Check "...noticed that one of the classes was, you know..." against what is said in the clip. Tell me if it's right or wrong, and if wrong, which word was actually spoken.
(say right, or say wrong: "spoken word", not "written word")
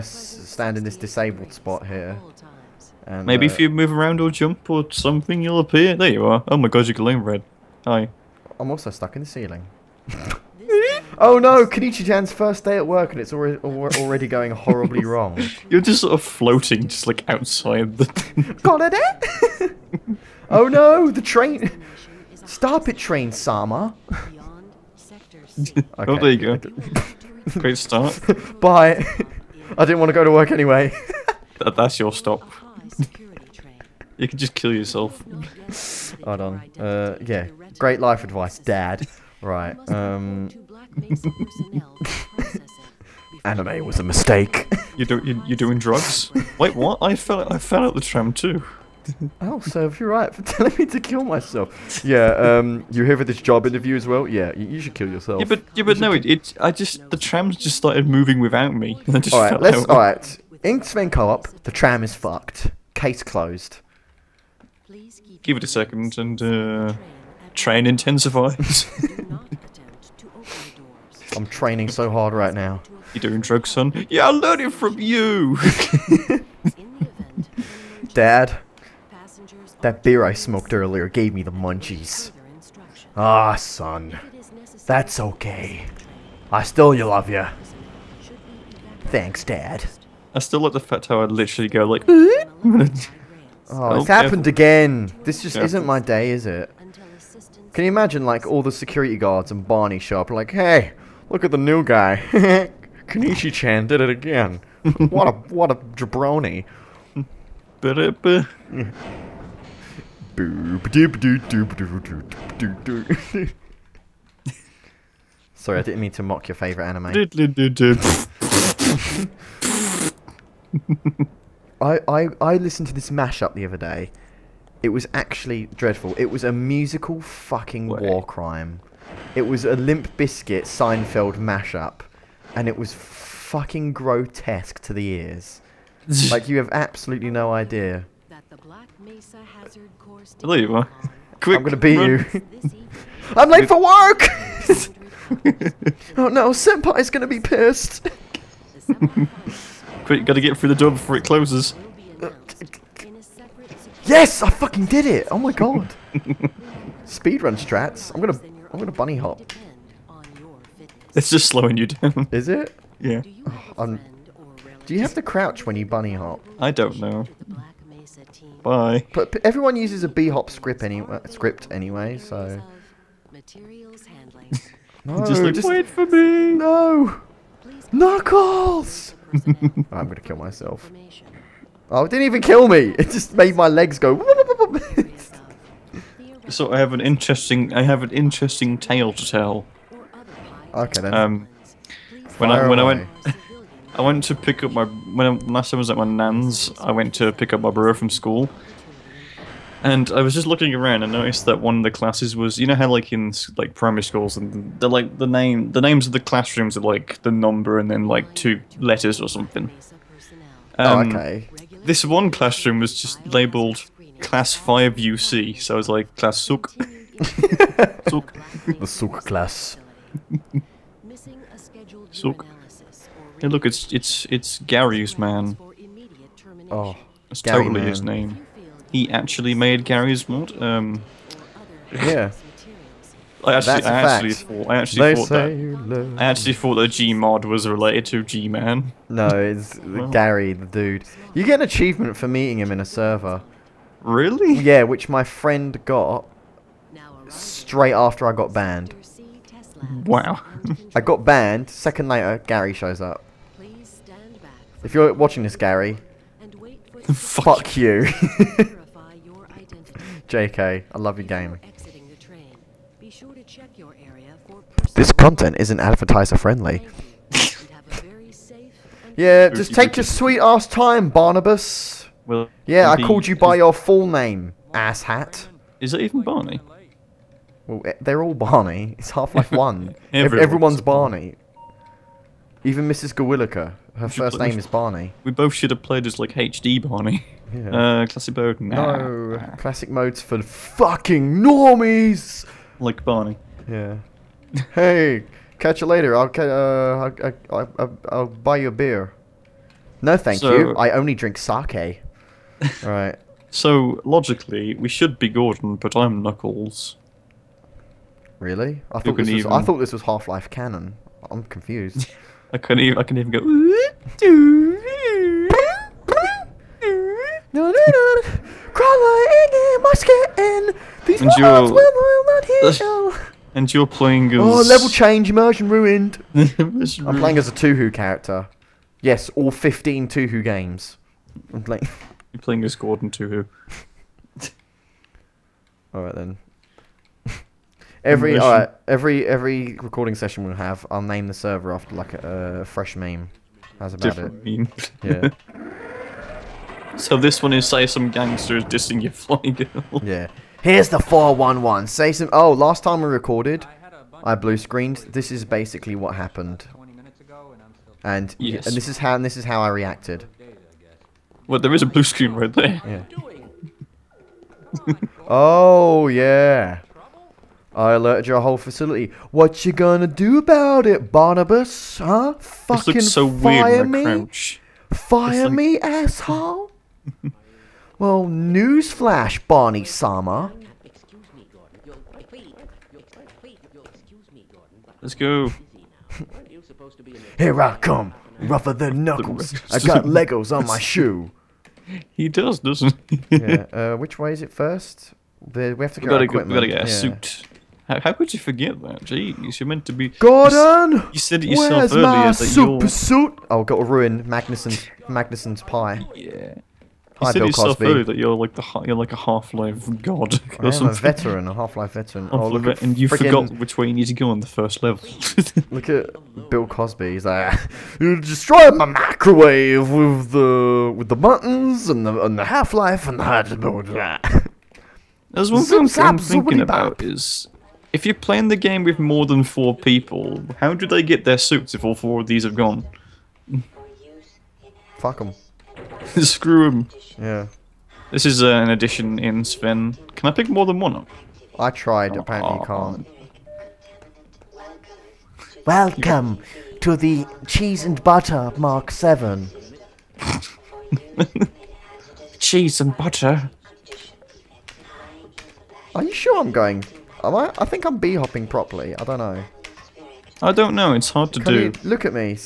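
right.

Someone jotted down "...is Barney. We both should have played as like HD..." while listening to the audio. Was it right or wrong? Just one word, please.
right.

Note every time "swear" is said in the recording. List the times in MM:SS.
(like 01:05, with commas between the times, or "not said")
not said.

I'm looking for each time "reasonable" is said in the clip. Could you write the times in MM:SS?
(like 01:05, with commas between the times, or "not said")
not said.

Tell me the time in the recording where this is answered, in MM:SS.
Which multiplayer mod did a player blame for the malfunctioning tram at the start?
01:00.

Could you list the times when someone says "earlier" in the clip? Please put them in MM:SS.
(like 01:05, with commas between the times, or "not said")
01:20, 06:41, 06:47.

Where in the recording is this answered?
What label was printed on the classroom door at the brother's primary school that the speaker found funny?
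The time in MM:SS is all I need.
03:34.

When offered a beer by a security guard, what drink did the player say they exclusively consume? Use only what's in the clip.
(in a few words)
sake.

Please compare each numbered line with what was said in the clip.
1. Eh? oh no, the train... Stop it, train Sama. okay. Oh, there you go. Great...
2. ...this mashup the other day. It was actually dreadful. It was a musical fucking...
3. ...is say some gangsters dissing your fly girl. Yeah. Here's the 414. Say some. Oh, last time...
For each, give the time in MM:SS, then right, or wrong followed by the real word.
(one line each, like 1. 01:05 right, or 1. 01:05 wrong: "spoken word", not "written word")
1. 00:18 right
2. 02:02 right
3. 05:47 wrong: "411", not "414".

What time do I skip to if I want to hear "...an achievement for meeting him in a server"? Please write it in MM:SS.
04:01.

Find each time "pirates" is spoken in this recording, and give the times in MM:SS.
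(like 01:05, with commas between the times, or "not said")
not said.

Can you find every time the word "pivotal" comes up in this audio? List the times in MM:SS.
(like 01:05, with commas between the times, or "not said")
not said.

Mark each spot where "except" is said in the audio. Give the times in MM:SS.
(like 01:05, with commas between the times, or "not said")
not said.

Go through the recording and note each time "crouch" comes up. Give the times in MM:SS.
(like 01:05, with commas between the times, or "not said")
02:45, 06:14.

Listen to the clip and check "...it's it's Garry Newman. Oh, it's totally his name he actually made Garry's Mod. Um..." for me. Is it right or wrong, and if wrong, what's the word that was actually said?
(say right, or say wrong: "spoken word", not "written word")
right.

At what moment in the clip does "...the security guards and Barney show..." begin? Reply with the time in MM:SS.
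01:38.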